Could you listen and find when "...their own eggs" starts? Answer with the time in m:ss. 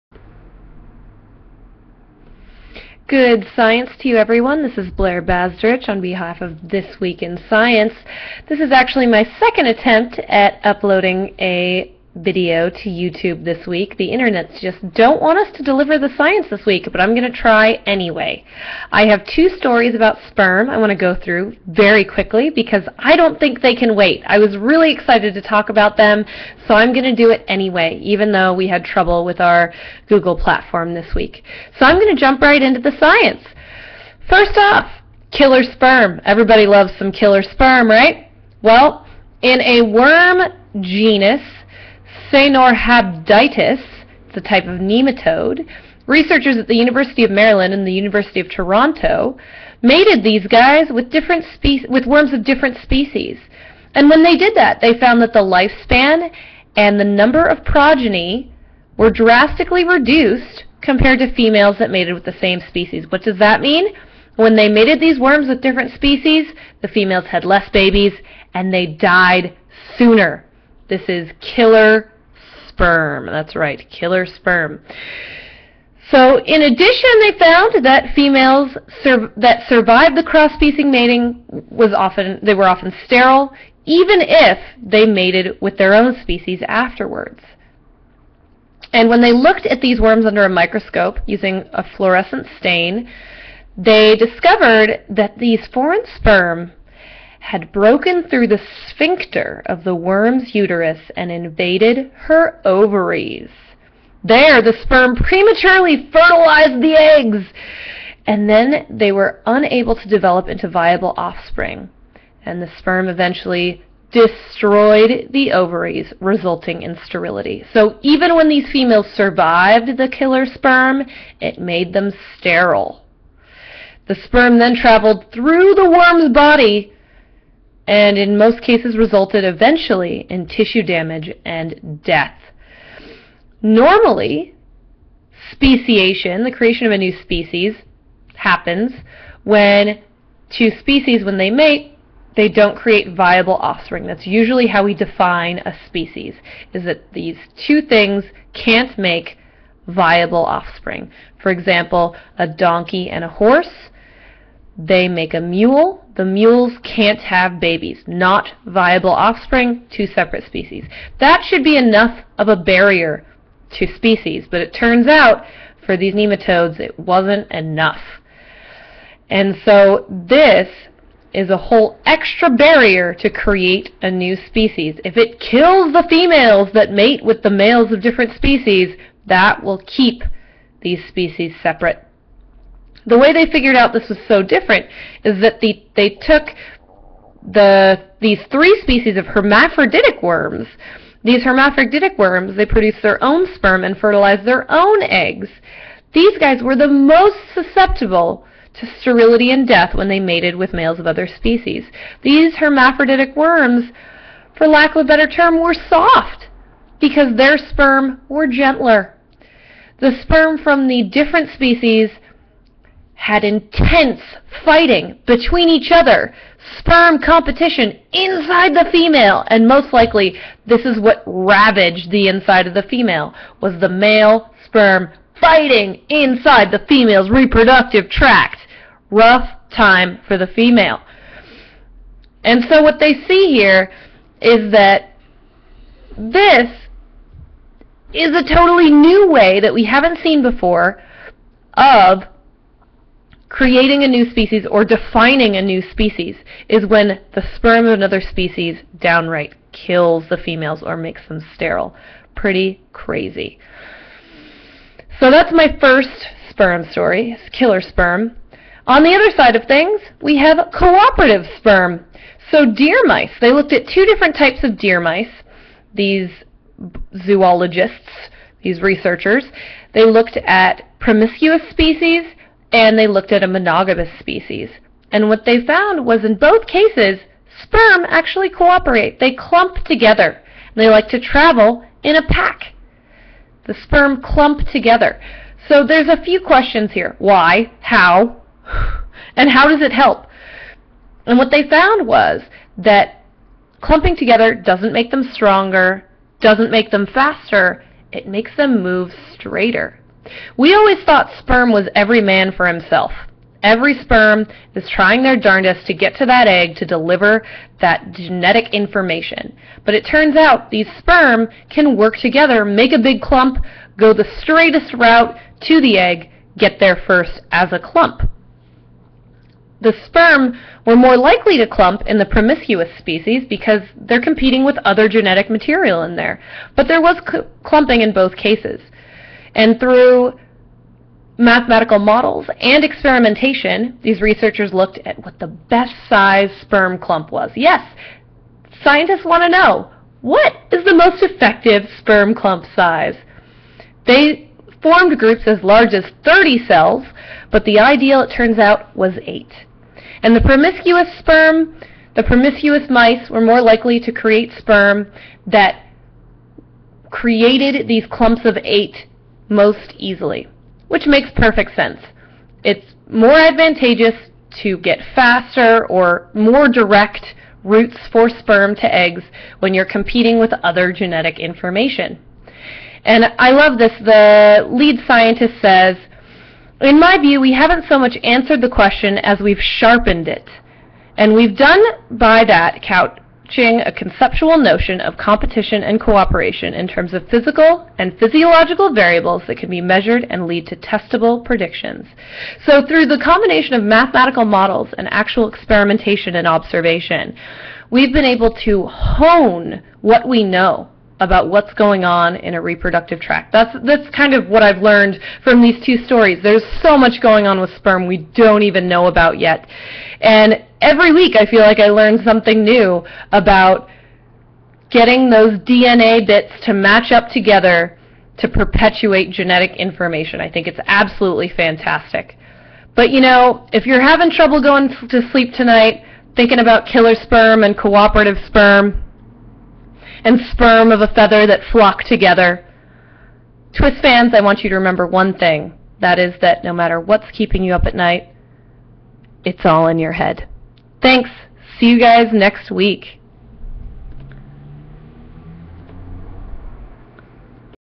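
3:14.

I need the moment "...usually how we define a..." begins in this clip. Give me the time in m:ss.
2:24.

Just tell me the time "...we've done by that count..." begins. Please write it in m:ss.
6:21.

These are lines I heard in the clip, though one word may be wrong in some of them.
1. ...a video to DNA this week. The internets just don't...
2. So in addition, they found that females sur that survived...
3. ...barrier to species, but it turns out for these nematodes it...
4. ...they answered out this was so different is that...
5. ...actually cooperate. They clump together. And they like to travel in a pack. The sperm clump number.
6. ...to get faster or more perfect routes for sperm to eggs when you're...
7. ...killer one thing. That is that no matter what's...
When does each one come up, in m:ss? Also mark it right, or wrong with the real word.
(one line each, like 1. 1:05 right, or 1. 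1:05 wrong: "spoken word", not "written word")
1. 0:11 wrong: "YouTube", not "DNA"
2. 1:16 right
3. 2:42 right
4. 3:03 wrong: "figured", not "answered"
5. 4:38 wrong: "together", not "number"
6. 6:04 wrong: "direct", not "perfect"
7. 7:14 wrong: "remember", not "killer".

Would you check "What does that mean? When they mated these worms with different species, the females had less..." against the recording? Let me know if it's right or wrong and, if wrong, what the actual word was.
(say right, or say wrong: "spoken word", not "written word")
right.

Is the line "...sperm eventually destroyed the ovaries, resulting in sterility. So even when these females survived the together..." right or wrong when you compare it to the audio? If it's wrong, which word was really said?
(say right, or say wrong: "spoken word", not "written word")
wrong: "killer", not "together".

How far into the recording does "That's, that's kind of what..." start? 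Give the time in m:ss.
6:43.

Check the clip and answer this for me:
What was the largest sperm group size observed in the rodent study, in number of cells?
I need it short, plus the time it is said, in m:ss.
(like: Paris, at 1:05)
30, at 5:46.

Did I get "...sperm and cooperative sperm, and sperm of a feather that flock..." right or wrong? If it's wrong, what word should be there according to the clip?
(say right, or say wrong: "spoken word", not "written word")
right.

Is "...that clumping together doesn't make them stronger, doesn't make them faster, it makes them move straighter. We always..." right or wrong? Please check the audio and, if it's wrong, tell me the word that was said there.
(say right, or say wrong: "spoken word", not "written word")
right.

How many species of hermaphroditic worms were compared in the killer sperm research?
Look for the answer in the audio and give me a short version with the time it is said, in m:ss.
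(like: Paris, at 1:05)
3, at 3:08.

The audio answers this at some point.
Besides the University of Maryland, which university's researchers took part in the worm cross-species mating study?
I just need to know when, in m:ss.
0:47.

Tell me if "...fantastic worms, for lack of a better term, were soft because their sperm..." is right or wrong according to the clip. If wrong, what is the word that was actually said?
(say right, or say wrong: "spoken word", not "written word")
wrong: "hermaphroditic", not "fantastic".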